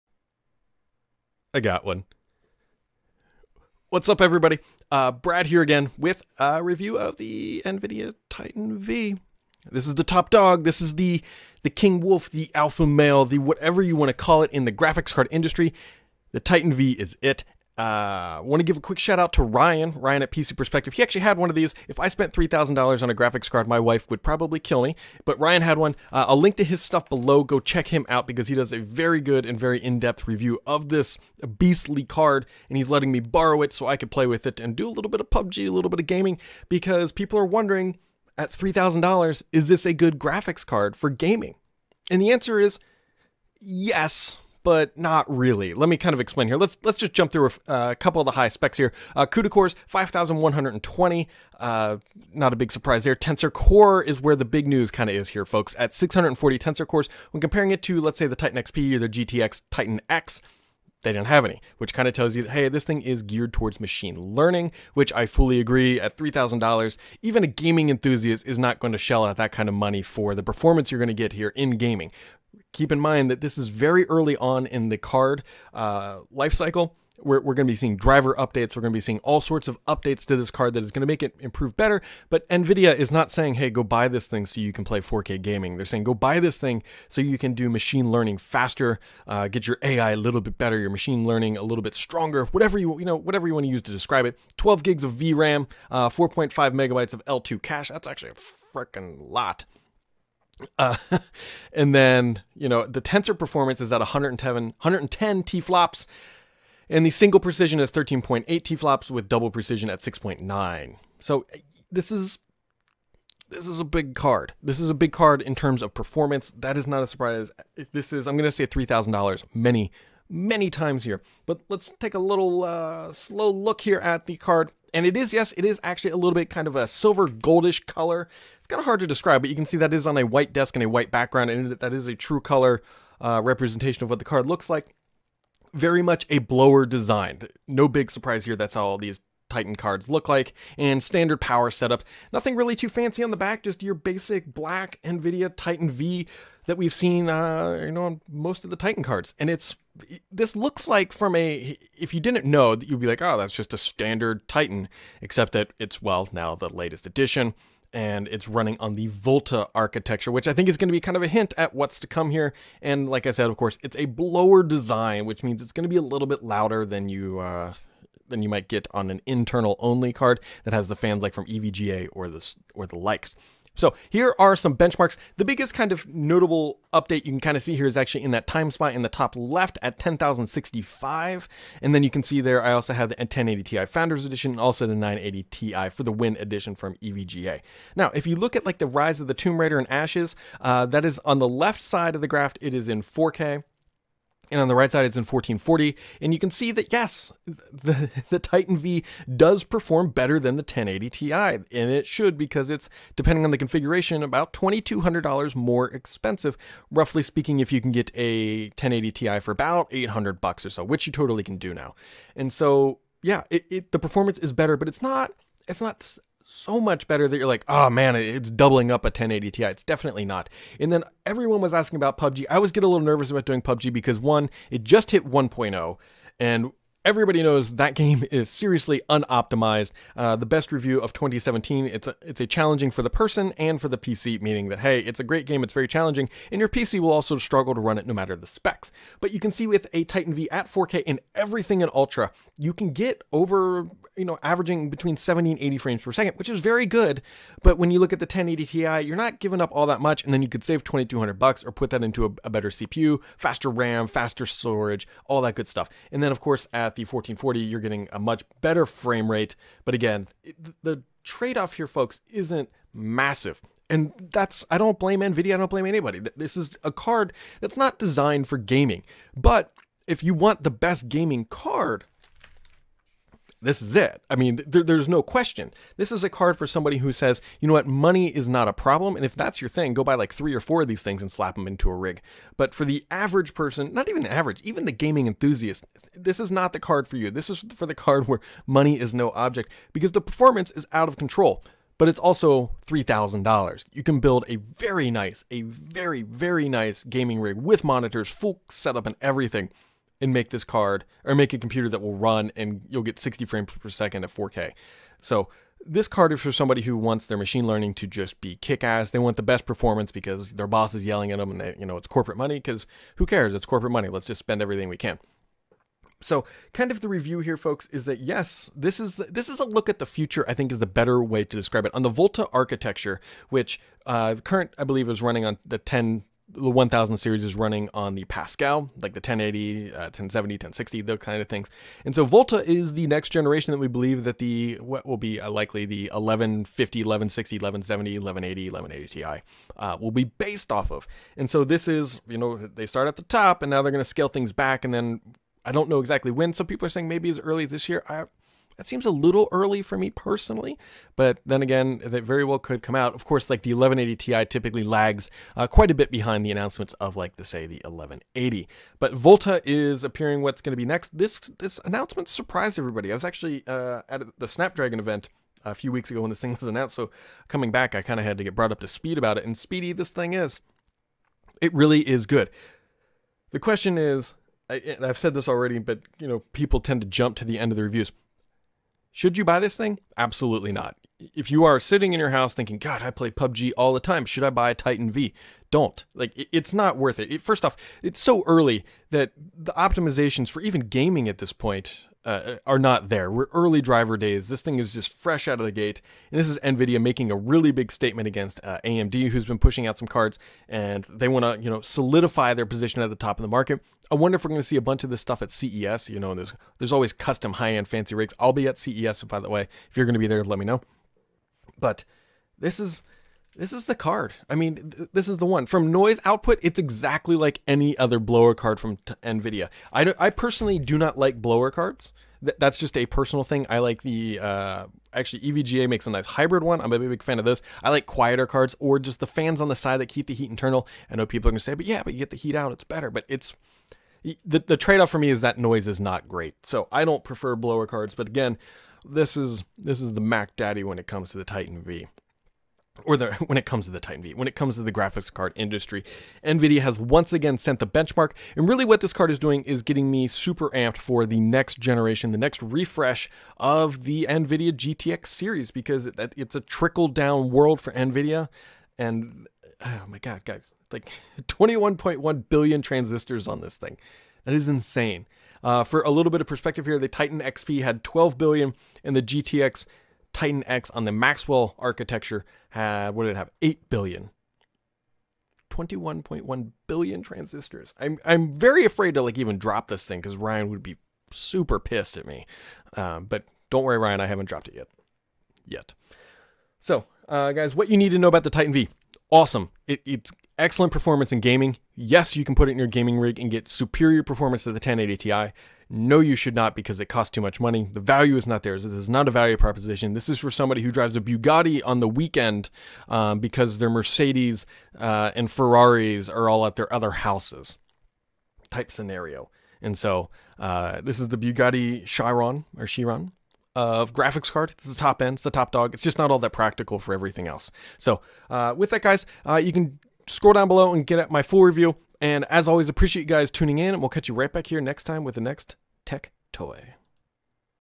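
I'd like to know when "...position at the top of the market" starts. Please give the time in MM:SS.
06:42.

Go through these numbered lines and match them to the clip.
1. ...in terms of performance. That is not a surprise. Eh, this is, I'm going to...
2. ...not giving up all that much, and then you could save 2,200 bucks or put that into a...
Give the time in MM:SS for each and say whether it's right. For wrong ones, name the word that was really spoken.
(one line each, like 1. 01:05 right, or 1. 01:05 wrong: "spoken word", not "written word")
1. 01:55 right
2. 04:09 right.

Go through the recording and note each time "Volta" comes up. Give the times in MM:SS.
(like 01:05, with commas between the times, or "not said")
02:39, 05:22, 05:32, 05:59.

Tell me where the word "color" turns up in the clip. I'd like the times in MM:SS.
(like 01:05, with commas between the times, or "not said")
02:07, 02:12.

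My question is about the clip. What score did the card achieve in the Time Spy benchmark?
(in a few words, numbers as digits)
10,065.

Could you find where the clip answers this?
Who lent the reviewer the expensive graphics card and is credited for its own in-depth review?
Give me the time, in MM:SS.
00:20.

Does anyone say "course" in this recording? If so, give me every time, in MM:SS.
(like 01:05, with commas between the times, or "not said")
02:43, 04:16, 05:53.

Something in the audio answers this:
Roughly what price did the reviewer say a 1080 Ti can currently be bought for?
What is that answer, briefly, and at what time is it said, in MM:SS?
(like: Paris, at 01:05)
800 bucks, at 03:29.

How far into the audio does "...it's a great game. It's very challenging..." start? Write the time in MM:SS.
03:54.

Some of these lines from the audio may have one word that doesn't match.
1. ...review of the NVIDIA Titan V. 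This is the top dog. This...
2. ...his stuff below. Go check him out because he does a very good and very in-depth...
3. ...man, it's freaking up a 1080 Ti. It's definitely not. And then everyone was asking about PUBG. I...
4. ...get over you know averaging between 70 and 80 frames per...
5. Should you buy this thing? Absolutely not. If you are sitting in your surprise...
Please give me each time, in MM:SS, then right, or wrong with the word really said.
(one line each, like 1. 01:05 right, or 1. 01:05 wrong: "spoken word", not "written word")
1. 00:06 right
2. 00:26 right
3. 03:37 wrong: "doubling", not "freaking"
4. 04:02 right
5. 06:19 wrong: "house", not "surprise".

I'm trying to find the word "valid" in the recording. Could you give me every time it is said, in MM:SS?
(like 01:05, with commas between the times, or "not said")
not said.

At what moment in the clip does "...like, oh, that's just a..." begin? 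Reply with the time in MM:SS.
02:33.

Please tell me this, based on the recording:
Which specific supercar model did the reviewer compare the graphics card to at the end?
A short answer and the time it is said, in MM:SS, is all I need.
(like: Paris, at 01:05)
Bugatti Chiron, at 08:31.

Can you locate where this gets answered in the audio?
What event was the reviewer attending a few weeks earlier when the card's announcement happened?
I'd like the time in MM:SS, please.
06:04.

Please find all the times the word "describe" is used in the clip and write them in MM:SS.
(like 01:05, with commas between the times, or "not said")
01:33, 02:09, 05:21.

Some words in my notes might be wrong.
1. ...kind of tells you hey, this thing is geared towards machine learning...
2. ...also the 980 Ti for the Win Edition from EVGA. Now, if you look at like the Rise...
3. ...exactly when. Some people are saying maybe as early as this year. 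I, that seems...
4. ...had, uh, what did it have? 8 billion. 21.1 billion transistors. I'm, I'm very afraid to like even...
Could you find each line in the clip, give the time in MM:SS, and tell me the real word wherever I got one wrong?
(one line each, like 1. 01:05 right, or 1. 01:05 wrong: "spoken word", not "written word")
1. 01:01 right
2. 03:04 right
3. 05:45 right
4. 07:52 right.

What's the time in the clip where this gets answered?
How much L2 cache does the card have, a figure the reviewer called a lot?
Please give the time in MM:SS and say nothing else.
01:36.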